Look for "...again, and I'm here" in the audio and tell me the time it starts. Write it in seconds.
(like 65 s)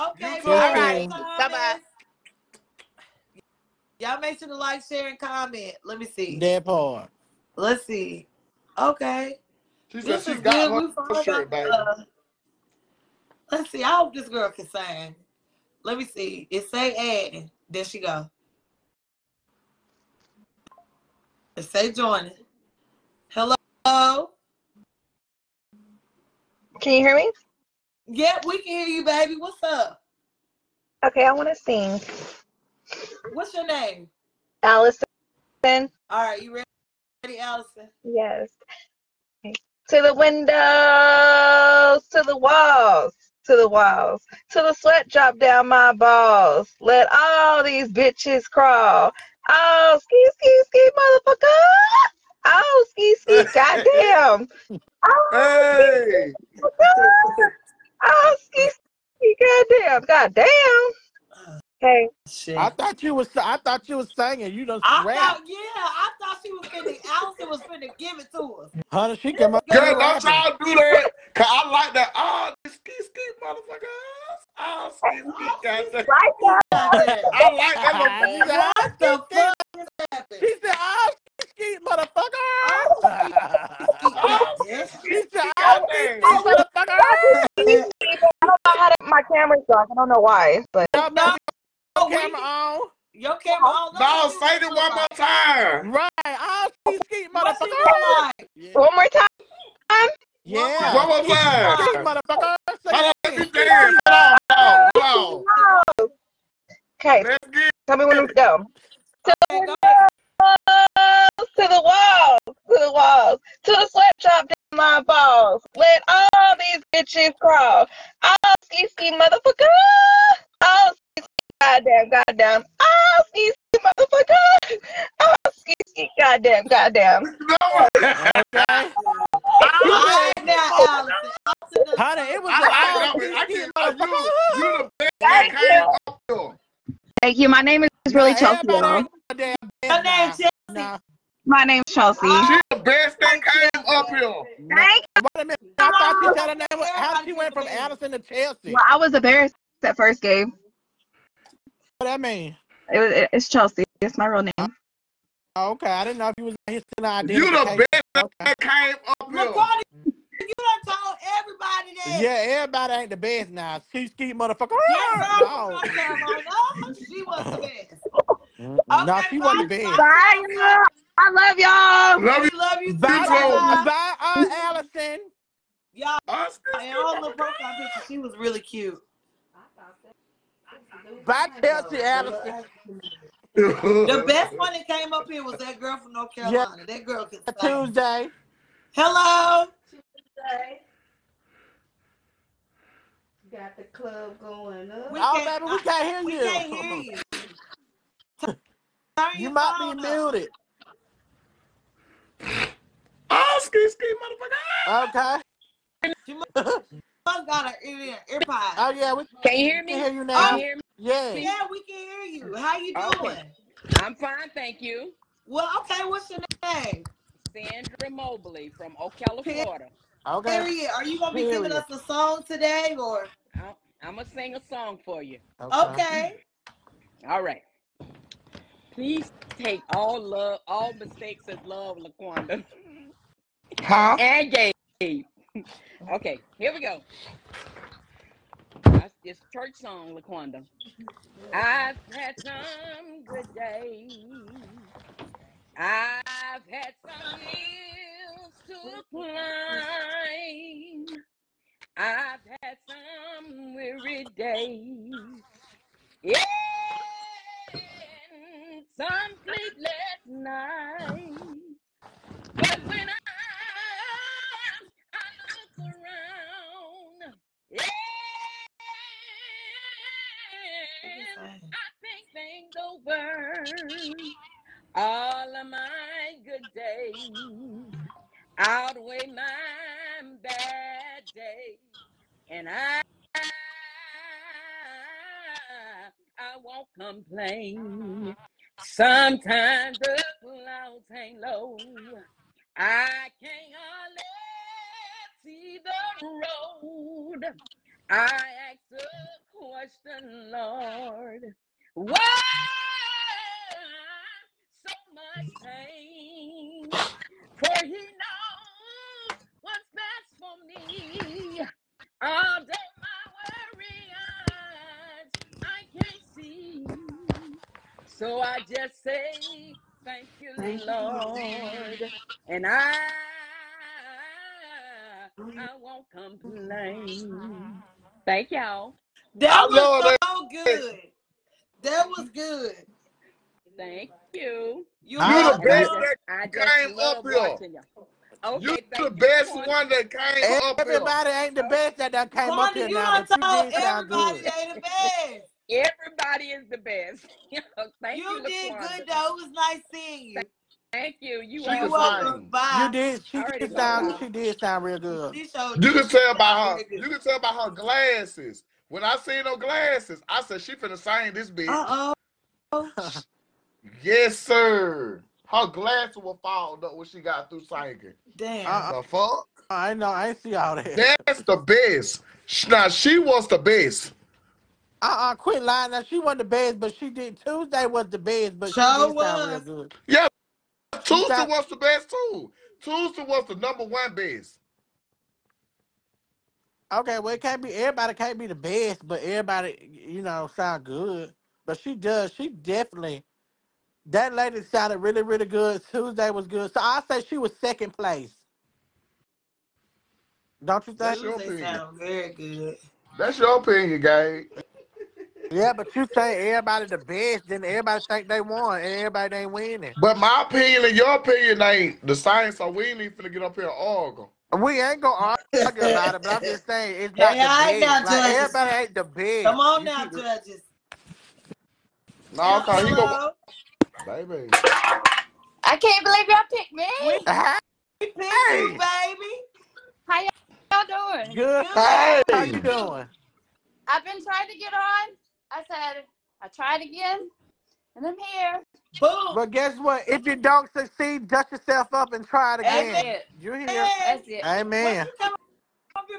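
436 s.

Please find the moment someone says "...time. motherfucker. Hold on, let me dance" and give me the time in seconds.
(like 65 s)
101 s.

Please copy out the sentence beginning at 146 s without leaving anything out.
How did you went from Addison to Chelsea?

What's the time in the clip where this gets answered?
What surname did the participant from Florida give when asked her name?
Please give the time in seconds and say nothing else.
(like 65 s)
217 s.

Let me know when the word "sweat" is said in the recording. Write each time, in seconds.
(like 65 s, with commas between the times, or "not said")
44 s, 113 s.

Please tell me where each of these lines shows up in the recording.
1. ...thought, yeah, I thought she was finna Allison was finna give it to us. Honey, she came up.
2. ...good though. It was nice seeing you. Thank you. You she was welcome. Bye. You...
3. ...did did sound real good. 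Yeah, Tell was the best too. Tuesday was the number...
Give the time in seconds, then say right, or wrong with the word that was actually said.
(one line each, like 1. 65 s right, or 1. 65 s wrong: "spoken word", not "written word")
1. 65 s right
2. 348 s right
3. 378 s wrong: "Tuesday", not "Tell".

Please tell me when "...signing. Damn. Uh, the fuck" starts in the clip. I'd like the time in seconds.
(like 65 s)
367 s.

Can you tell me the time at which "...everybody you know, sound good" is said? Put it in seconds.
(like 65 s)
389 s.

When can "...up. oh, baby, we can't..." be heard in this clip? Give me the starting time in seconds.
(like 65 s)
194 s.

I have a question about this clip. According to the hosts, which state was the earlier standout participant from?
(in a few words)
North Carolina.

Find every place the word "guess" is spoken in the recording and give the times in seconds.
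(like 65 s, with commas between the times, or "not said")
439 s.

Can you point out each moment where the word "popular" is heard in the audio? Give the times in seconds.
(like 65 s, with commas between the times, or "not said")
not said.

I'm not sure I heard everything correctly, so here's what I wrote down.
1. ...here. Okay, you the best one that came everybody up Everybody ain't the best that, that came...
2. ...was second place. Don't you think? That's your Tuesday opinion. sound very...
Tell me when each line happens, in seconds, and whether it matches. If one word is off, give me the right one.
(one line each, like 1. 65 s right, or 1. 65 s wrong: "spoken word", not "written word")
1. 337 s right
2. 397 s right.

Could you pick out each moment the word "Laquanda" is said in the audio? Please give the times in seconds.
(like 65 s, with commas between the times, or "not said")
231 s, 240 s.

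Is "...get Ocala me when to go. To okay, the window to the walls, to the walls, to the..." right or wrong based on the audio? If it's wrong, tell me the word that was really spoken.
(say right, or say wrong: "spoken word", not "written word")
wrong: "Tell", not "Ocala".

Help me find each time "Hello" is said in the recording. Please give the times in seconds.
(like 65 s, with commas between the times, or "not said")
23 s, 188 s.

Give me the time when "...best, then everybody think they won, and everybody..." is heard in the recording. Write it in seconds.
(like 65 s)
406 s.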